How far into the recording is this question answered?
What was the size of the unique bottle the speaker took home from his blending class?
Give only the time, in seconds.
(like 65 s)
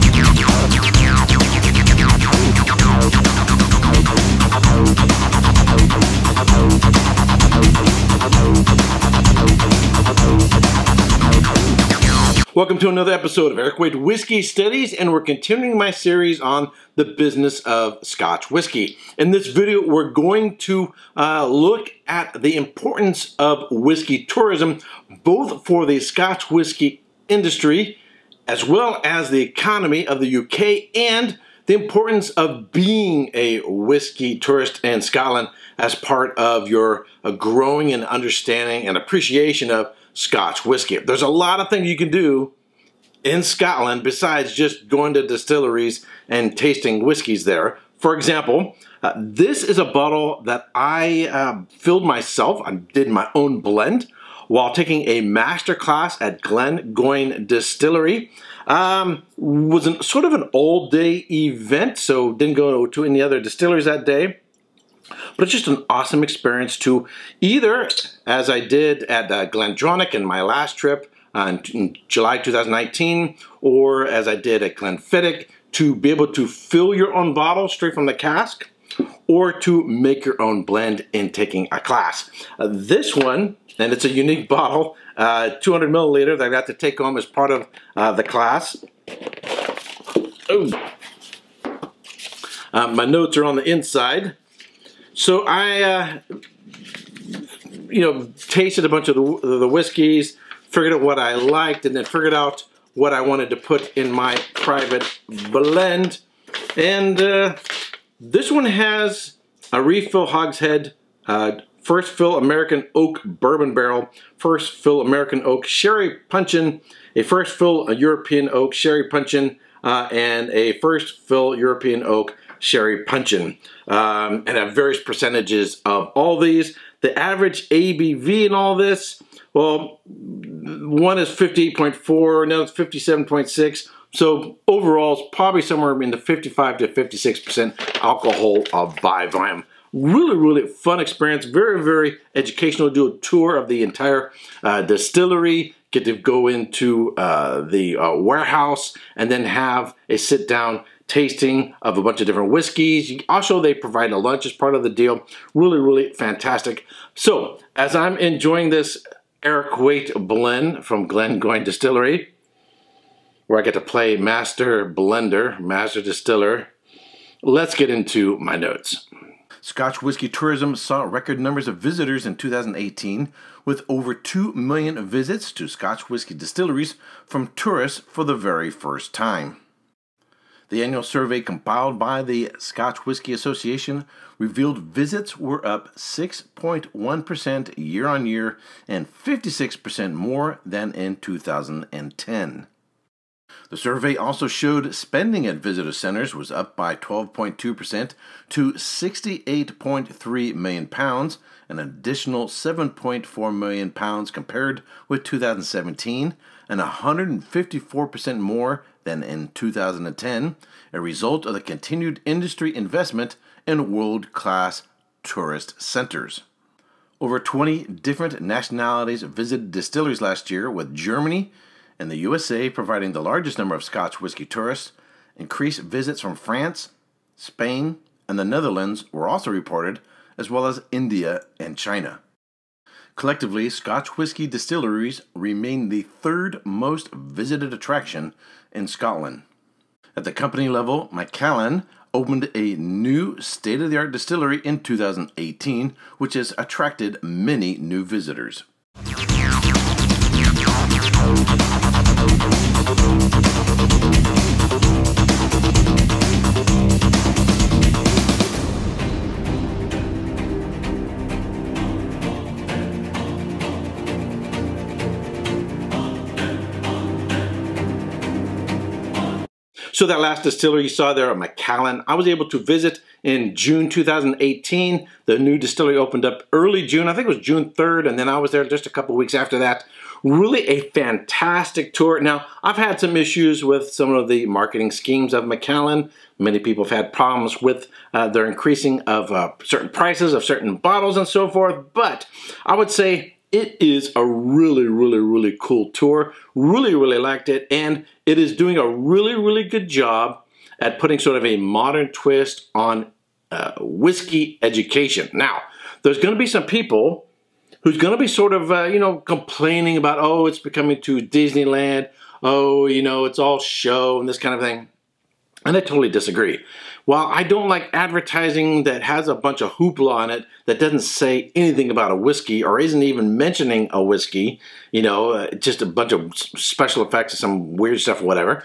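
85 s.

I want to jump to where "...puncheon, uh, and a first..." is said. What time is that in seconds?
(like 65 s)
119 s.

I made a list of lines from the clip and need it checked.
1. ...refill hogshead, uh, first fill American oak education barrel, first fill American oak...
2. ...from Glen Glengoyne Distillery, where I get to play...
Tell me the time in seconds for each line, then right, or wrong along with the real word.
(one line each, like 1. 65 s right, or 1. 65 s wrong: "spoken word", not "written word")
1. 109 s wrong: "bourbon", not "education"
2. 160 s right.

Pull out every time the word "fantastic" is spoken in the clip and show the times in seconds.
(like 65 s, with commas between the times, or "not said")
156 s, 280 s.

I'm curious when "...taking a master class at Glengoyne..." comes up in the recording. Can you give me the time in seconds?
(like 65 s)
54 s.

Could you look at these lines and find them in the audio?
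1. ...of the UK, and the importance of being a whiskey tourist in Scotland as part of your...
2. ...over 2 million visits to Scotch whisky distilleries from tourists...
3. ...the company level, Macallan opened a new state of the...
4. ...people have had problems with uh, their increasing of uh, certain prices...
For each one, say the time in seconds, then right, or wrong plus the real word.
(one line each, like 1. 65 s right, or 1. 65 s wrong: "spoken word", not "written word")
1. 30 s right
2. 173 s right
3. 240 s right
4. 286 s right.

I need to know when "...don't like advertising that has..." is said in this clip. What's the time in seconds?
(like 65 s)
317 s.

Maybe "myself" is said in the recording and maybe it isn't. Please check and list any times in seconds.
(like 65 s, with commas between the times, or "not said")
52 s.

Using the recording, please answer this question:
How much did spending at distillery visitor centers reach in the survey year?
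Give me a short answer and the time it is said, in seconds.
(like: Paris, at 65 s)
68.3 million pounds, at 198 s.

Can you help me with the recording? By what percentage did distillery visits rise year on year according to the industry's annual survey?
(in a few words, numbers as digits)
6.1%.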